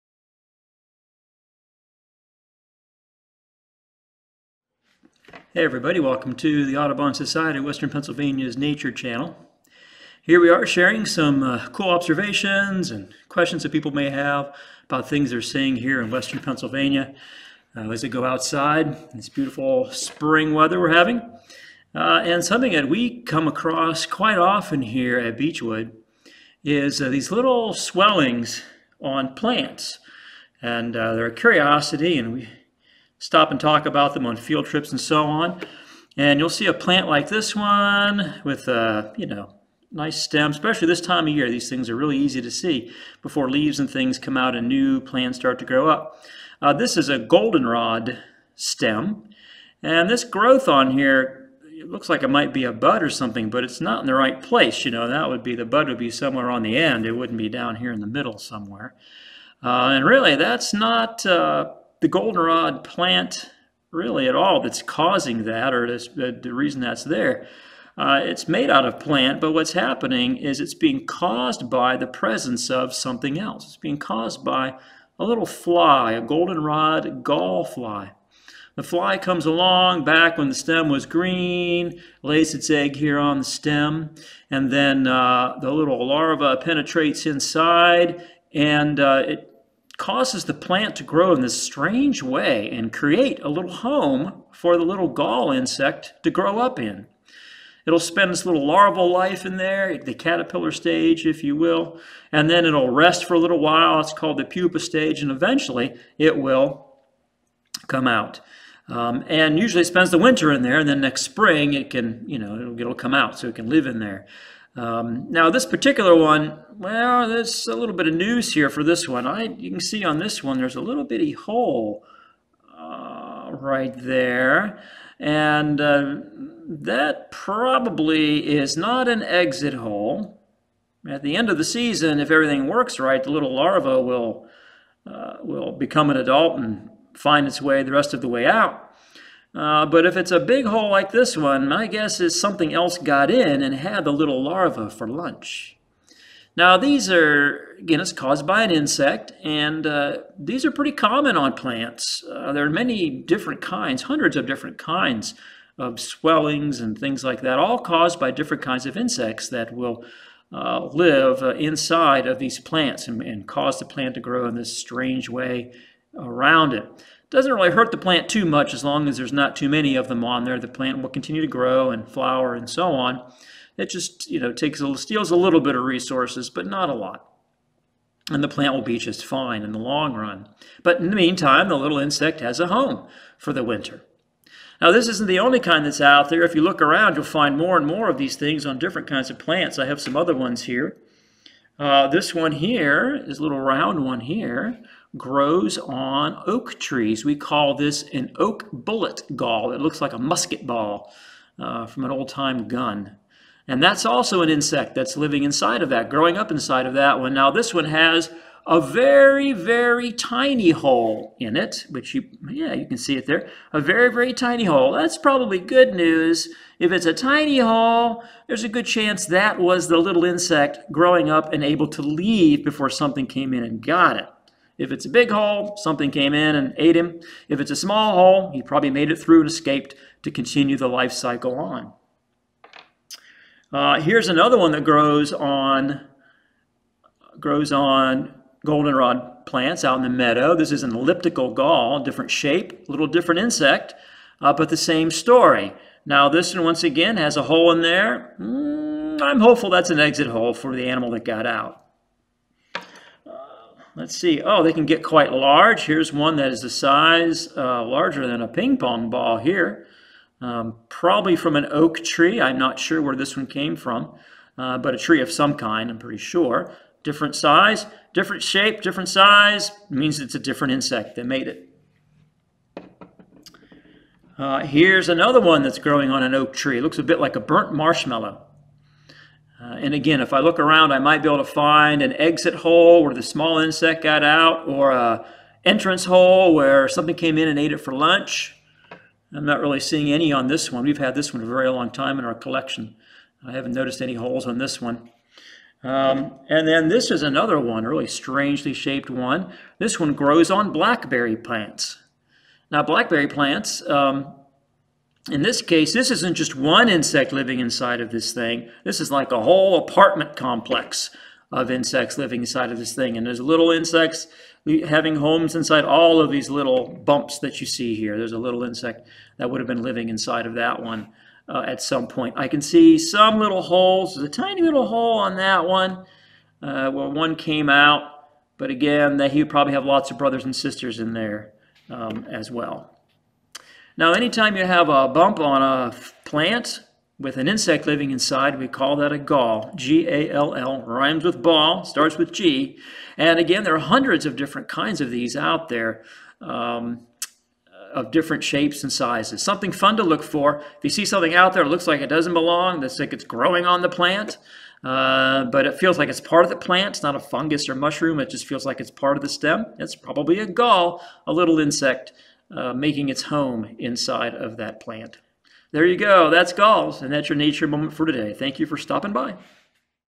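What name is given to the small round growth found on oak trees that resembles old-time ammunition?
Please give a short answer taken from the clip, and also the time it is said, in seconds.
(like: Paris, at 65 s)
Oak bullet gall, at 198 s.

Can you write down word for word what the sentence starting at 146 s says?
Now these are, again, it's caused by an insect, and uh, these are pretty common on plants.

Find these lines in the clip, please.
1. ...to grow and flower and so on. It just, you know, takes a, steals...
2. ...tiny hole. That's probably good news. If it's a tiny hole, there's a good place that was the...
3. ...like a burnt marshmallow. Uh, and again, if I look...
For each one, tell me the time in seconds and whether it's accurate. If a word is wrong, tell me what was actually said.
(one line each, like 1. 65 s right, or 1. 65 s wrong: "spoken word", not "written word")
1. 171 s right
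2. 214 s wrong: "chance", not "place"
3. 277 s right.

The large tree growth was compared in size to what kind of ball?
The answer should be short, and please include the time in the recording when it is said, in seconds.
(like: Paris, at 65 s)
Ping pong ball, at 258 s.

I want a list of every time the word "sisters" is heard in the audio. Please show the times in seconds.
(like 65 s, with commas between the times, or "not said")
330 s.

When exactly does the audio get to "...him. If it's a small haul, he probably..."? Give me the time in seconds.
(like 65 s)
226 s.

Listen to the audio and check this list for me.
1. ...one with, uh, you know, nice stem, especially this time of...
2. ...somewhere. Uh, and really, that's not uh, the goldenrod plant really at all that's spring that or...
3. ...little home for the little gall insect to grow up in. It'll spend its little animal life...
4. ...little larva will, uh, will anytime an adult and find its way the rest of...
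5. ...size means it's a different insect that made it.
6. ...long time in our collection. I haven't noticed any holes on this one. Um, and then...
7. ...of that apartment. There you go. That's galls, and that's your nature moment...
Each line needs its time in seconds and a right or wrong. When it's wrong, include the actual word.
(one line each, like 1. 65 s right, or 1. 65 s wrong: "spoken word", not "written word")
1. 37 s right
2. 58 s wrong: "causing", not "spring"
3. 93 s wrong: "larval", not "animal"
4. 133 s wrong: "become", not "anytime"
5. 269 s right
6. 291 s right
7. 364 s wrong: "plant", not "apartment".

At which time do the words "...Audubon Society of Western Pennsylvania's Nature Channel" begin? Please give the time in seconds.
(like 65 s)
6 s.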